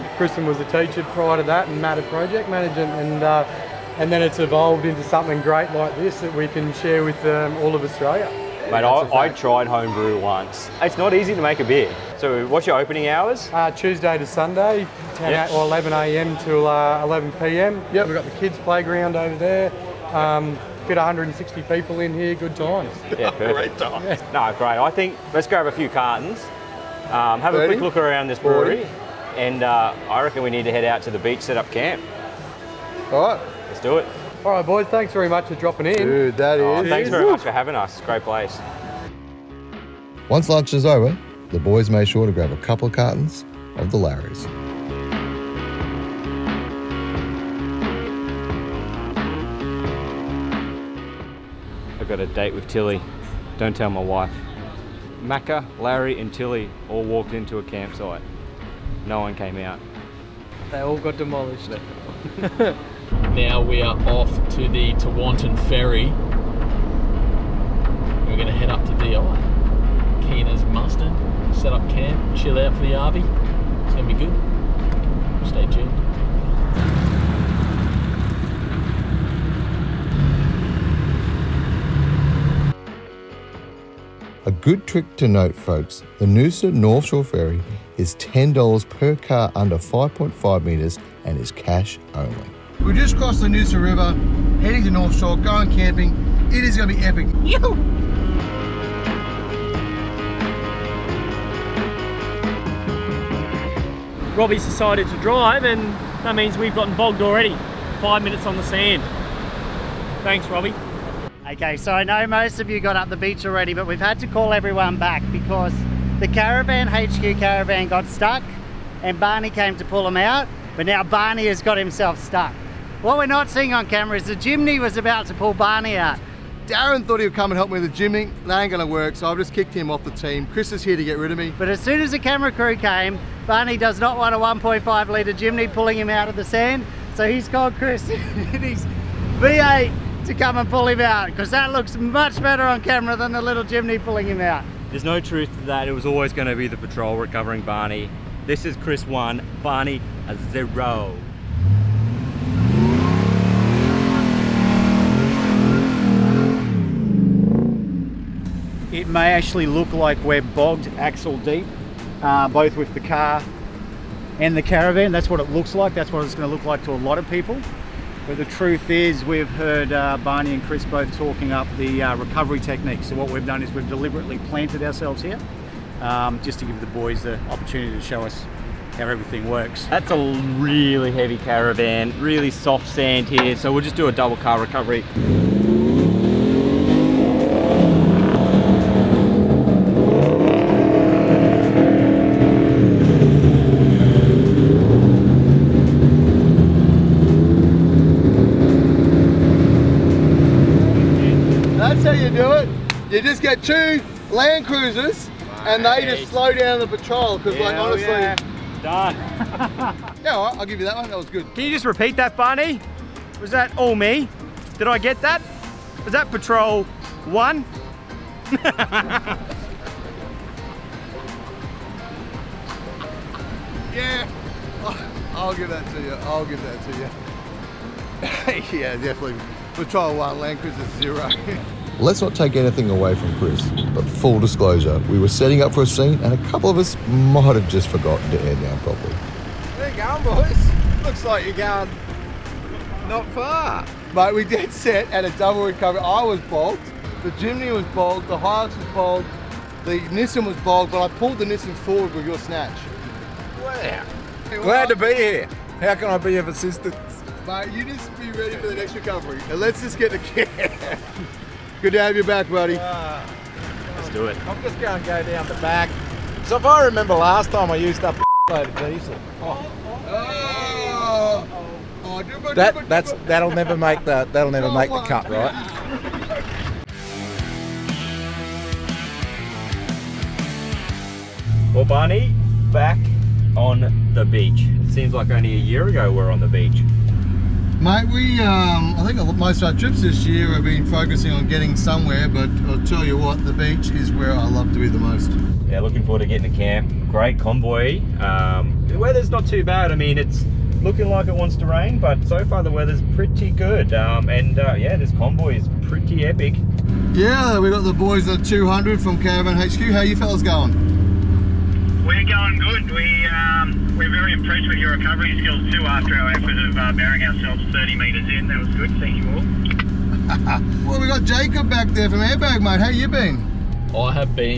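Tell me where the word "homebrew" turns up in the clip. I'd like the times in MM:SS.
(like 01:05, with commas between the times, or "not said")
00:09.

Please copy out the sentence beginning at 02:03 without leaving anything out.
What we're not seeing on camera is the Jimny was about to pull Barney out.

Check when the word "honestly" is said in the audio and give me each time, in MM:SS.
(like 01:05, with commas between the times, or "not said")
03:27.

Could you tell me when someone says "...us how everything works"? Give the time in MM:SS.
02:58.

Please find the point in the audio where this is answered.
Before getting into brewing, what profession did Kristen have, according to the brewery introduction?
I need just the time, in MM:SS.
00:00.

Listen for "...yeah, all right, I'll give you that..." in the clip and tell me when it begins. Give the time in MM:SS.
03:30.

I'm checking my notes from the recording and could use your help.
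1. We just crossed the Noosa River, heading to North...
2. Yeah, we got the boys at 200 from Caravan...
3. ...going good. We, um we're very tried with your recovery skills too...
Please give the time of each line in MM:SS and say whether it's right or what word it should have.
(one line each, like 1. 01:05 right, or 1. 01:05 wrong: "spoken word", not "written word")
1. 01:32 right
2. 05:07 right
3. 05:12 wrong: "impressed", not "tried".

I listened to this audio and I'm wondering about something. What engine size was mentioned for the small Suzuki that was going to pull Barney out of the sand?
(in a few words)
1.5 litre.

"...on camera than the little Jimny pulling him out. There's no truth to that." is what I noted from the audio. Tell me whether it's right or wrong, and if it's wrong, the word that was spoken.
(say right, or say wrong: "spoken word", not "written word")
right.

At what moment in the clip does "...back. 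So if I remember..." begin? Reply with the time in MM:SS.
04:25.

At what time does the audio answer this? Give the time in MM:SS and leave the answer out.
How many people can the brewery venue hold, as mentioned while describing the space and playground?
00:20.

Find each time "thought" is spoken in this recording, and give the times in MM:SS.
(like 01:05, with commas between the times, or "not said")
02:07.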